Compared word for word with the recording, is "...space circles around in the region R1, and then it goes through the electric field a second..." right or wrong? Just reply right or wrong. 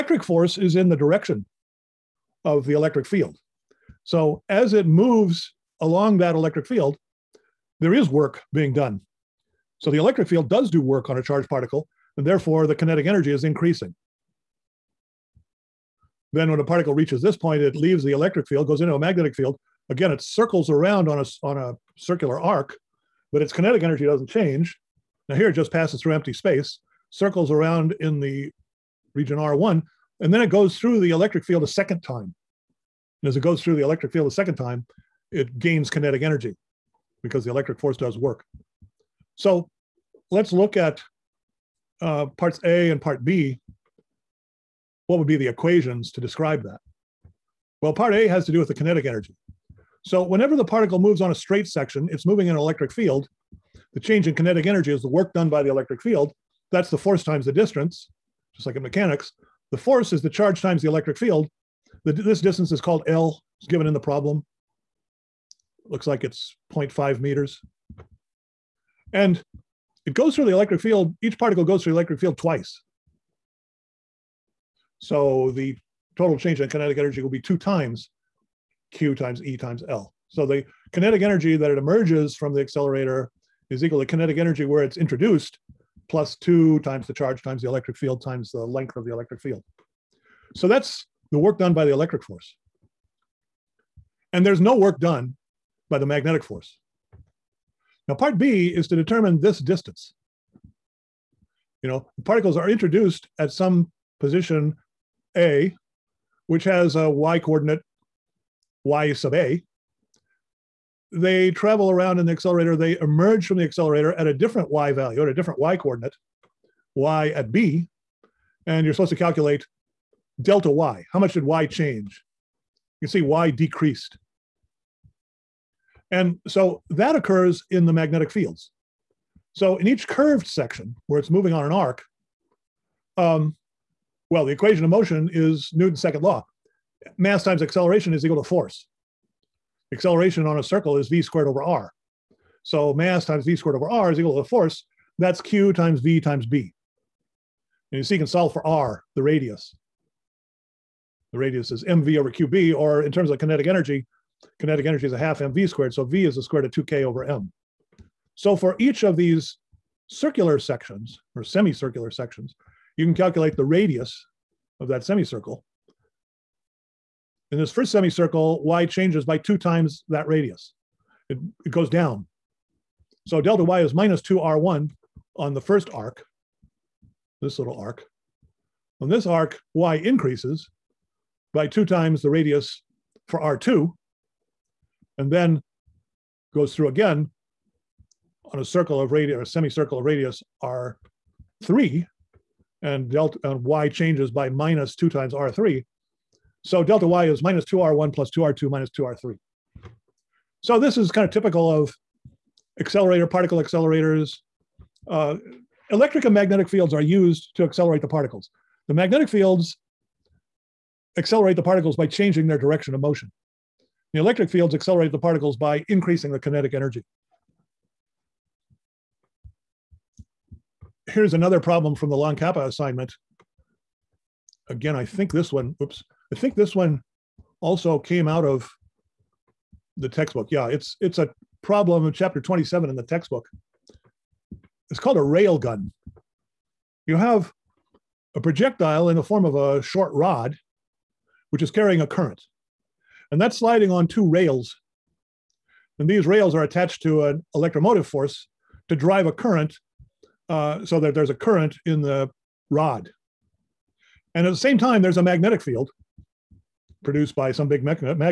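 right.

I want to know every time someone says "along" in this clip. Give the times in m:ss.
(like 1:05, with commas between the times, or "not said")
0:05.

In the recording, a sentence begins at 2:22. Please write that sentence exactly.
So mass times v squared over r is equal to the force.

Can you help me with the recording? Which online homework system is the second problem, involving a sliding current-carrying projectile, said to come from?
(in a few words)
LON-CAPA.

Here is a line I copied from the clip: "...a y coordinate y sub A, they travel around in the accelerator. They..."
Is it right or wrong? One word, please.
right.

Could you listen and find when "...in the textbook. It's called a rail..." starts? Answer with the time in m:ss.
3:52.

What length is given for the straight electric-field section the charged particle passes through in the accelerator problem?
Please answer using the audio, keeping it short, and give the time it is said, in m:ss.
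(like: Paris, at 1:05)
0.5 meters, at 1:06.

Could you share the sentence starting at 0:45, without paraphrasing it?
What would be the equations to describe that?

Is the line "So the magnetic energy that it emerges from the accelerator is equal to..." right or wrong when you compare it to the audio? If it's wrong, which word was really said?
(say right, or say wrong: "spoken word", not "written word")
wrong: "kinetic", not "magnetic".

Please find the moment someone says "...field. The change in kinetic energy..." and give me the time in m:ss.
0:52.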